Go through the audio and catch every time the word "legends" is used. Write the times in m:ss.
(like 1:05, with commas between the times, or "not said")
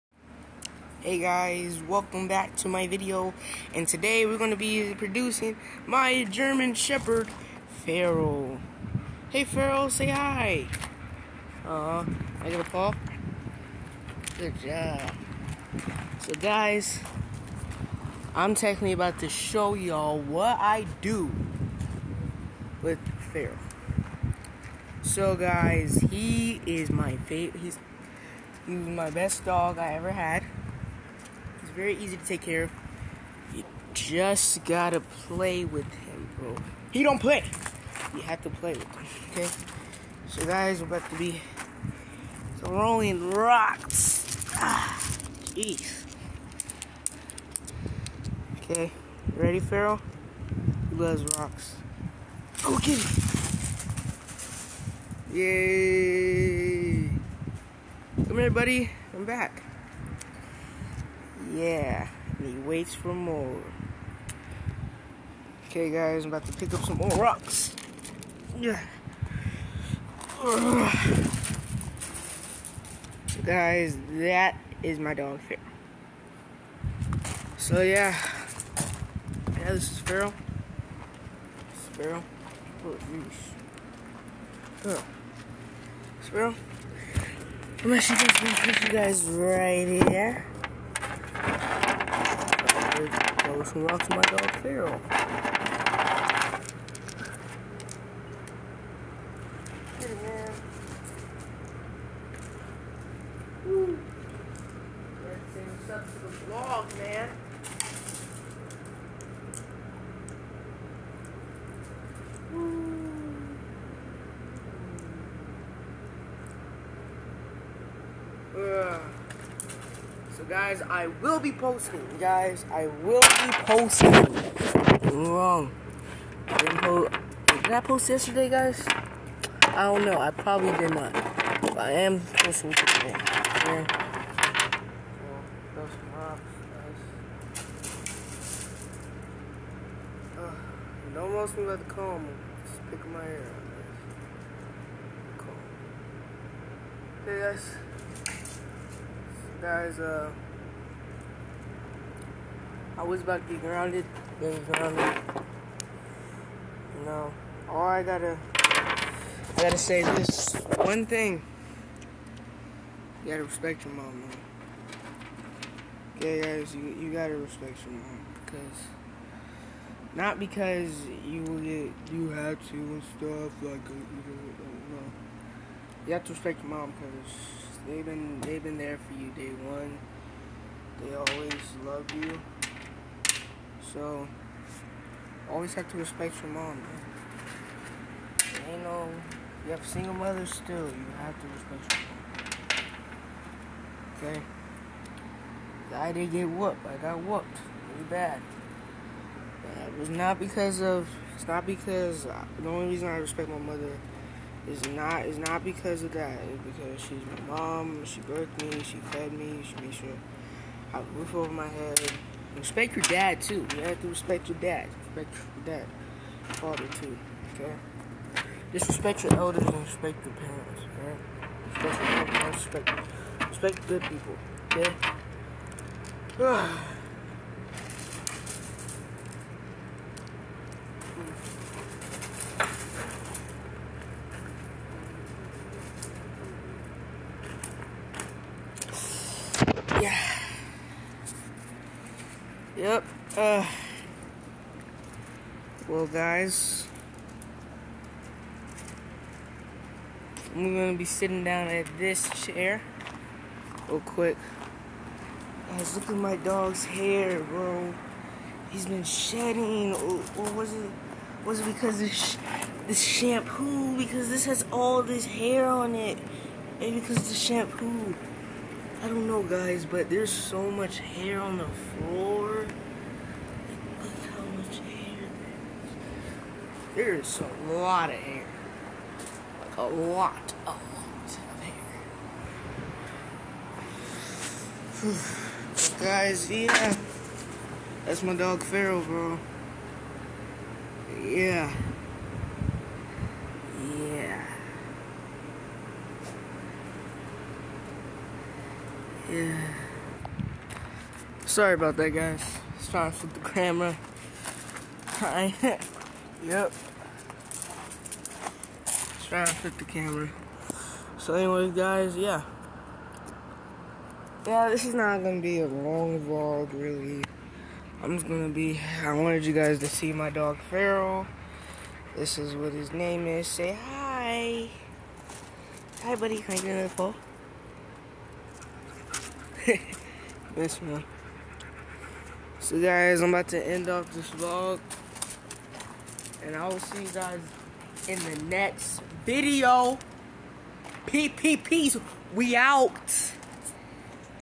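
not said.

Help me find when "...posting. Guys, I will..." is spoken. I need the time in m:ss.
2:01.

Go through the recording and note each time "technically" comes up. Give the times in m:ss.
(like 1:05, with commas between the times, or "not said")
0:18.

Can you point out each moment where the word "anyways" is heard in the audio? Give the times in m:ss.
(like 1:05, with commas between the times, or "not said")
5:11.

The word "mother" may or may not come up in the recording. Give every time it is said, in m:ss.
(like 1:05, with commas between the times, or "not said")
3:10, 3:23.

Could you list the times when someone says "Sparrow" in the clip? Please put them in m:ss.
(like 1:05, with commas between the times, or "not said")
1:21, 1:26.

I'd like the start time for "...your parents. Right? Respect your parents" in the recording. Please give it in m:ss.
3:40.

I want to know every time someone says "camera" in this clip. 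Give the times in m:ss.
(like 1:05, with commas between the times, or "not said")
5:03, 5:09.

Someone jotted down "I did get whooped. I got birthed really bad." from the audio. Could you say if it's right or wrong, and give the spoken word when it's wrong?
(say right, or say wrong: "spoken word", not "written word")
wrong: "whooped", not "birthed".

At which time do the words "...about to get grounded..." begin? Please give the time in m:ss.
2:33.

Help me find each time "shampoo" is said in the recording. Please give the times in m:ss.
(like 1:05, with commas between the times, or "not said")
4:22, 4:27.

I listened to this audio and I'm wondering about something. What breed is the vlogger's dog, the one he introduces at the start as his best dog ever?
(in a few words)
German Shepherd.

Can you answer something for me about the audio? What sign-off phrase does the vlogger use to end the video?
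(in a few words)
PPPs, we out.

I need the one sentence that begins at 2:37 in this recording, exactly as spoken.
all I gotta, I gotta say this one thing.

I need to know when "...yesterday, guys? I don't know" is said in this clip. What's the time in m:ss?
2:08.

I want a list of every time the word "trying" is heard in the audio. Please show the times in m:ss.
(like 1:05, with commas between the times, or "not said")
5:02, 5:09.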